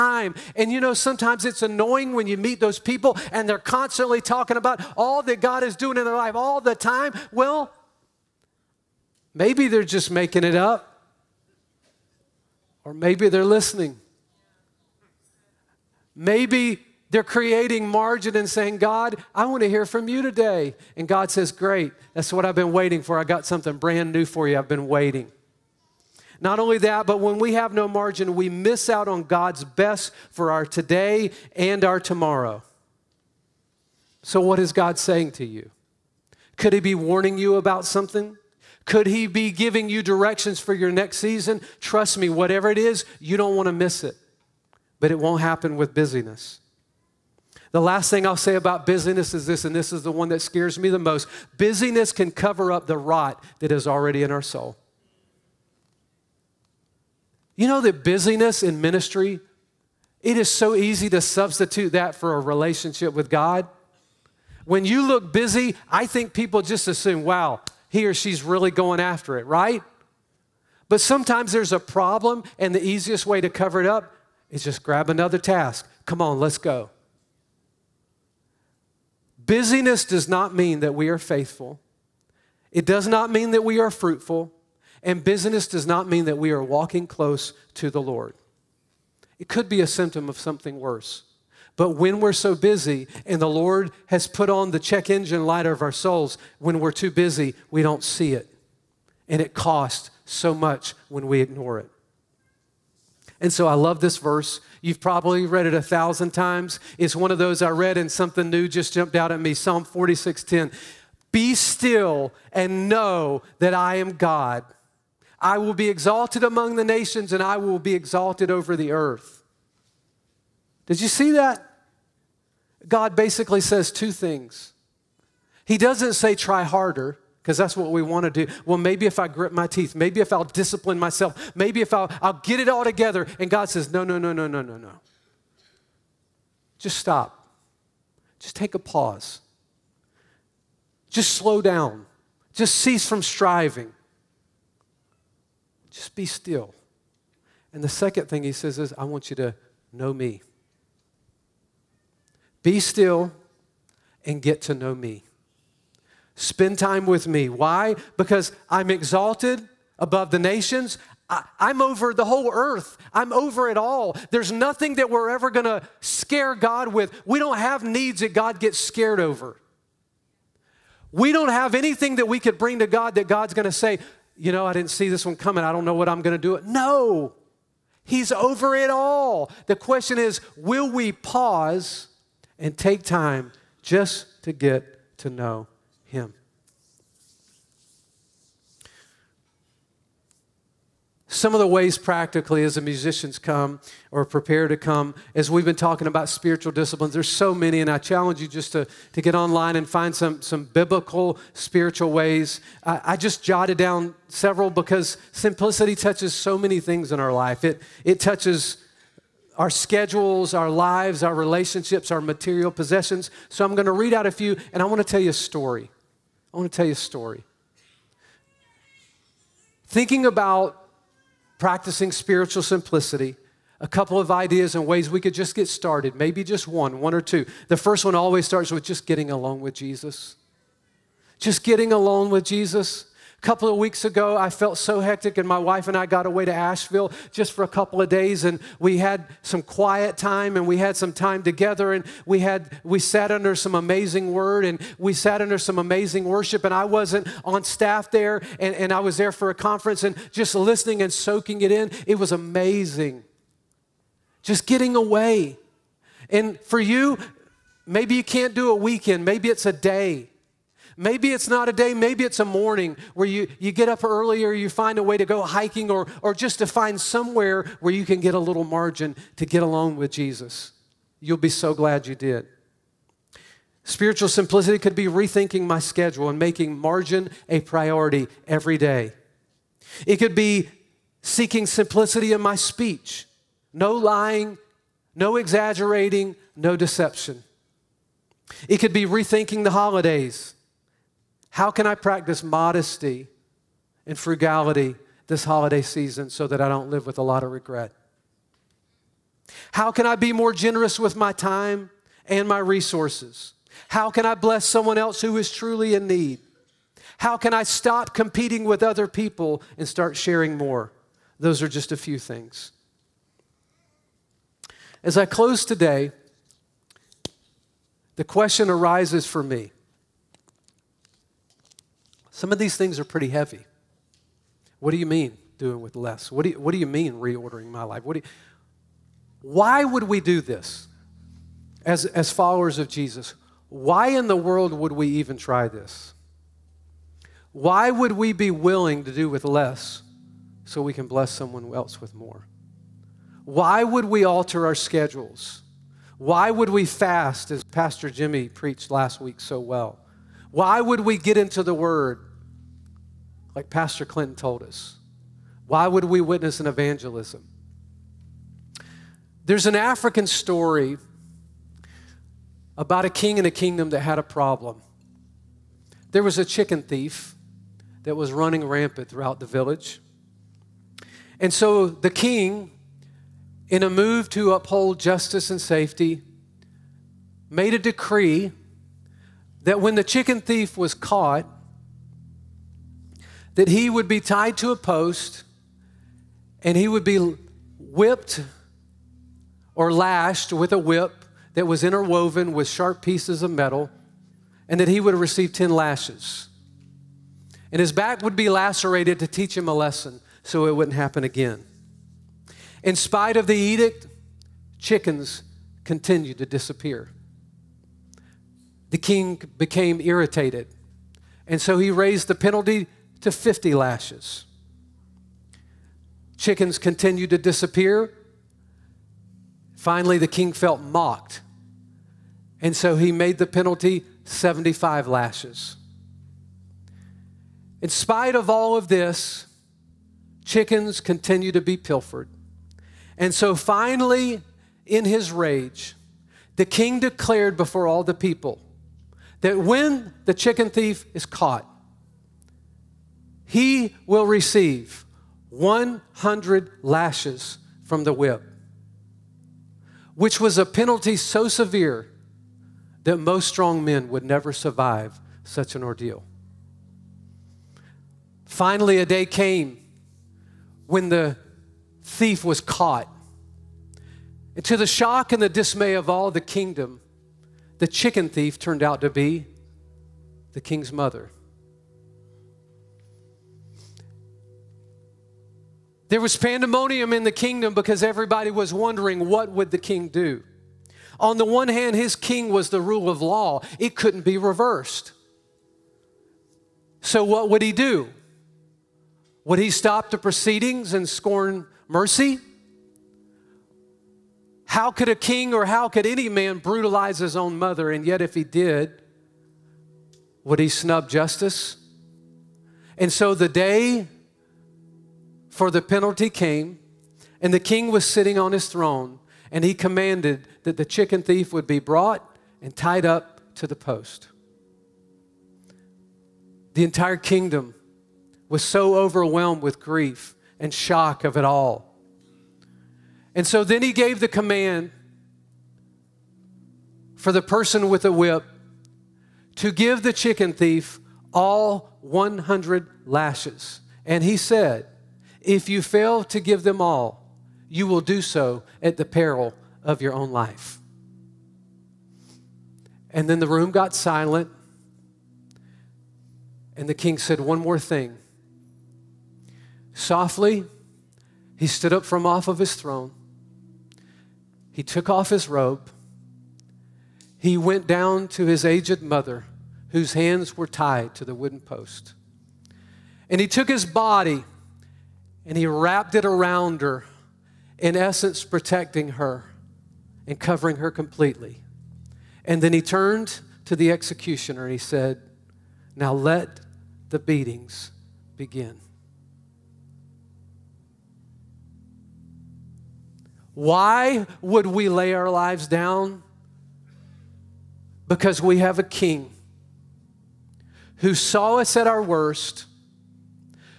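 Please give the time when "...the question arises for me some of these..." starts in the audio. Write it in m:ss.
5:18.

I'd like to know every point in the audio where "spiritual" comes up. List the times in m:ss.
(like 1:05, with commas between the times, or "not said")
3:16, 3:21, 3:42, 4:33.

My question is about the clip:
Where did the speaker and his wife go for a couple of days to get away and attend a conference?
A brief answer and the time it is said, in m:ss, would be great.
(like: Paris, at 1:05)
Asheville, at 3:56.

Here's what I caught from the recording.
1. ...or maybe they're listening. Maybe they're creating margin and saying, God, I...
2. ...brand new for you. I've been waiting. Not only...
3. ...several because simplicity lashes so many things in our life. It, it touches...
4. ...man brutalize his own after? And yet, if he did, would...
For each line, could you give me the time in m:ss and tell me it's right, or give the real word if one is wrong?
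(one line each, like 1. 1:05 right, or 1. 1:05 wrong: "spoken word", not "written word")
1. 0:12 right
2. 0:23 right
3. 3:24 wrong: "touches", not "lashes"
4. 8:16 wrong: "mother", not "after".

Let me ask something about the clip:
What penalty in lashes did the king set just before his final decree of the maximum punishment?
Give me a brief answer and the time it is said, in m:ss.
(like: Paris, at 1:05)
75, at 7:04.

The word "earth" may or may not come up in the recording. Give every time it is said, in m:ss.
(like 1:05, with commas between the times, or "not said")
1:58, 2:42.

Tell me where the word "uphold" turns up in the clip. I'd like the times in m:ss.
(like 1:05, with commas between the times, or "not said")
6:14.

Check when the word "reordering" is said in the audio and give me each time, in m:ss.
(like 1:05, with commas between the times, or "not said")
5:27.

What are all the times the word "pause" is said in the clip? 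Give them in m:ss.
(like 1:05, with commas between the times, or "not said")
2:18, 3:01.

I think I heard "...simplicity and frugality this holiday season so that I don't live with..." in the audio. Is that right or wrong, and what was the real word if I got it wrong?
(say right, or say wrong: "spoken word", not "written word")
wrong: "modesty", not "simplicity".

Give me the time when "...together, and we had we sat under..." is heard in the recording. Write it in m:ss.
4:01.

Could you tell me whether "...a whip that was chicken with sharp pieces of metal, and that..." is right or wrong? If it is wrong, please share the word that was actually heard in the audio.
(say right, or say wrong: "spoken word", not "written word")
wrong: "interwoven", not "chicken".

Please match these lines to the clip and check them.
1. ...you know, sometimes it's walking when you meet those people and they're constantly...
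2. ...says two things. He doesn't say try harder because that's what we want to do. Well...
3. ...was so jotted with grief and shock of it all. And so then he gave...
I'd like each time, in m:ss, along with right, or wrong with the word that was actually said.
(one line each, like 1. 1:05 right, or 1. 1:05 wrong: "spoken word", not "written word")
1. 0:00 wrong: "annoying", not "walking"
2. 2:03 right
3. 8:38 wrong: "overwhelmed", not "jotted".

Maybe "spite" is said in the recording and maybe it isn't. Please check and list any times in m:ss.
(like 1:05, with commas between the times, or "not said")
6:42, 7:07.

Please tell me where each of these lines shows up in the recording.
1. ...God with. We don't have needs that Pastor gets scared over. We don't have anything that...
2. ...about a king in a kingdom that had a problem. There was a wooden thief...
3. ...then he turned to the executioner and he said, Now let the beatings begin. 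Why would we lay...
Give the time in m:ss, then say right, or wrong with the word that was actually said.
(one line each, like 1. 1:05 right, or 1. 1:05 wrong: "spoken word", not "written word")
1. 2:46 wrong: "God", not "Pastor"
2. 6:02 wrong: "chicken", not "wooden"
3. 9:32 right.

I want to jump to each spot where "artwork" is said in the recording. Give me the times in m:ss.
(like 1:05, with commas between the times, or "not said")
not said.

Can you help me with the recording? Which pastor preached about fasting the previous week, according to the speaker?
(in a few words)
Pastor Jimmy.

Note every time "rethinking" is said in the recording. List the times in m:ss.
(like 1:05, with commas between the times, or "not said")
4:35, 4:49.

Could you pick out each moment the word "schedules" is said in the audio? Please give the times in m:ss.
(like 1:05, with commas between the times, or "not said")
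3:29, 4:35, 5:44.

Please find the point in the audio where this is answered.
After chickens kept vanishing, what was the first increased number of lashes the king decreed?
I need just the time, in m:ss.
6:53.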